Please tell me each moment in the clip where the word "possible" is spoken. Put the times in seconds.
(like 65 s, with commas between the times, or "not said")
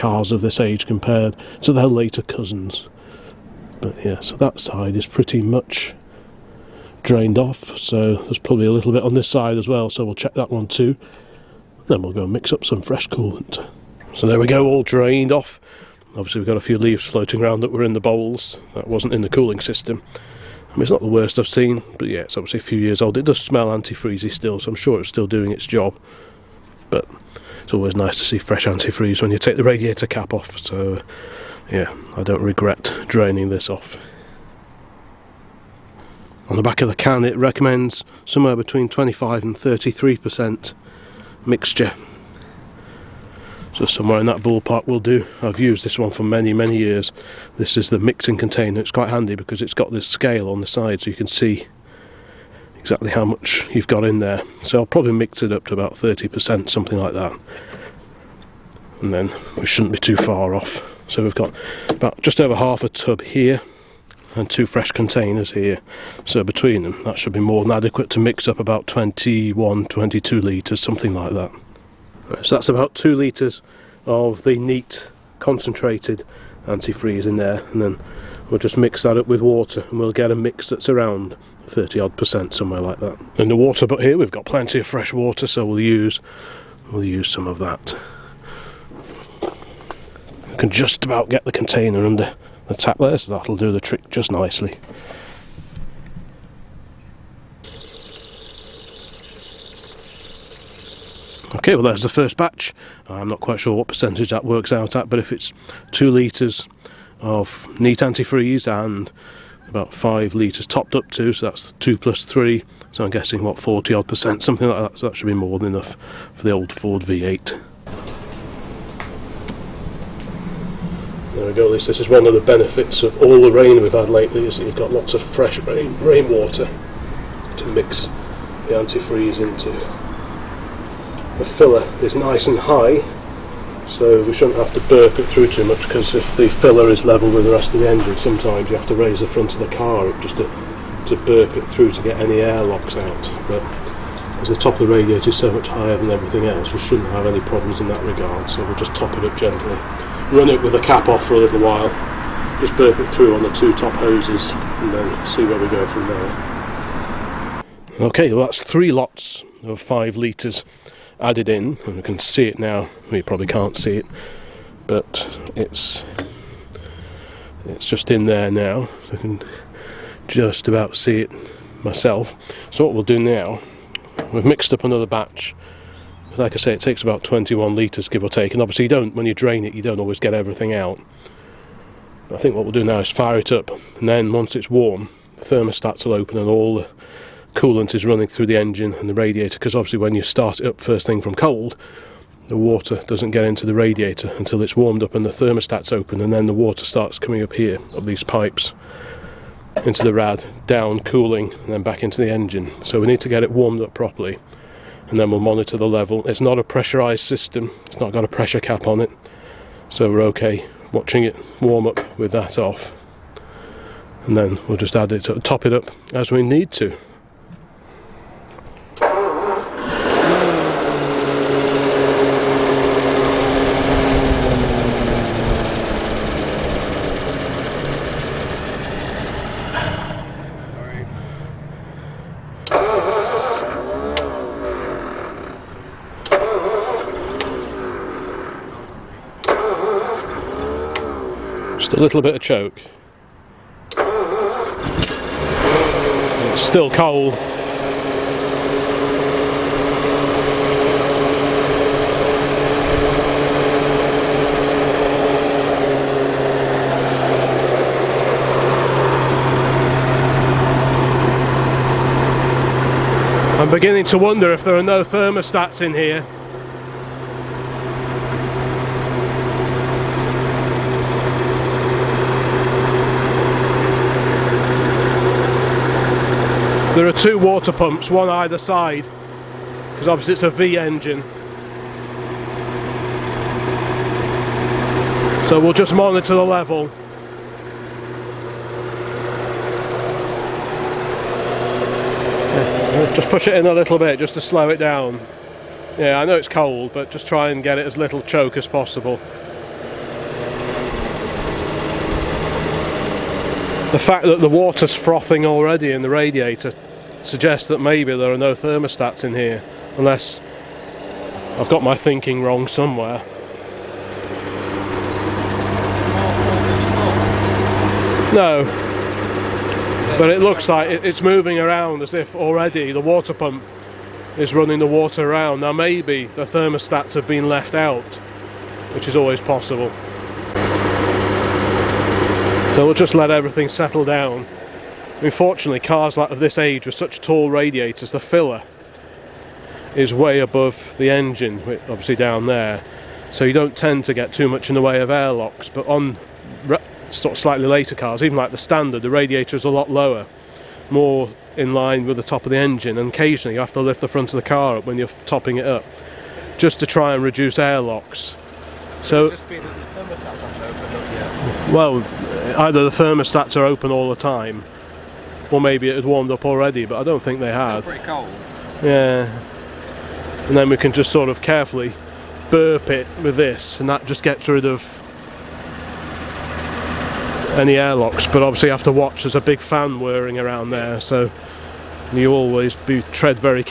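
298 s, 329 s.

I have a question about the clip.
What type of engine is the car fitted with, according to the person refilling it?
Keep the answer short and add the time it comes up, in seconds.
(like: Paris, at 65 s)
Ford V8, at 116 s.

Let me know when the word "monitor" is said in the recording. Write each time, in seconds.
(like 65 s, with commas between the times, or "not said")
205 s, 285 s.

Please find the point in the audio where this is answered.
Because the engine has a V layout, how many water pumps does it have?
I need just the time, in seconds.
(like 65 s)
277 s.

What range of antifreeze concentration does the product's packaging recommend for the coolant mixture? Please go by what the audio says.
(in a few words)
25 and 33%.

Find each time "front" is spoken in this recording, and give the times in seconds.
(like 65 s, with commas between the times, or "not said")
139 s, 354 s.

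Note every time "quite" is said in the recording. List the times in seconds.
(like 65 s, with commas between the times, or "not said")
48 s, 103 s.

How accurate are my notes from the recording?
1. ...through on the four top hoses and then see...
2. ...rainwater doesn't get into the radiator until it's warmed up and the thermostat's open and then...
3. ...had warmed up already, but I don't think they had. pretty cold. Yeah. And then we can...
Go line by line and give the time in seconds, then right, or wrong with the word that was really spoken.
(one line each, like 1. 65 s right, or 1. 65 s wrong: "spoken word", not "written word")
1. 153 s wrong: "two", not "four"
2. 192 s wrong: "water", not "rainwater"
3. 365 s right.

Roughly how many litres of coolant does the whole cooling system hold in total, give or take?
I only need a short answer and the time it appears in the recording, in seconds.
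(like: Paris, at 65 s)
21 litres, at 177 s.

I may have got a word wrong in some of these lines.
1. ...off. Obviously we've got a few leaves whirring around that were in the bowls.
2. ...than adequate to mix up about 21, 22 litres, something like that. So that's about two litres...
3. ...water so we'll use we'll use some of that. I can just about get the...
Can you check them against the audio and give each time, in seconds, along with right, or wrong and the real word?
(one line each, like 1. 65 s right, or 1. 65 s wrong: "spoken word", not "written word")
1. 15 s wrong: "floating", not "whirring"
2. 67 s right
3. 85 s right.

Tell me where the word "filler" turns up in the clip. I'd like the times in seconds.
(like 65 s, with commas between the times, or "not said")
131 s, 136 s, 338 s.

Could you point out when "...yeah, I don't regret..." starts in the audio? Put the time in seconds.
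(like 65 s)
31 s.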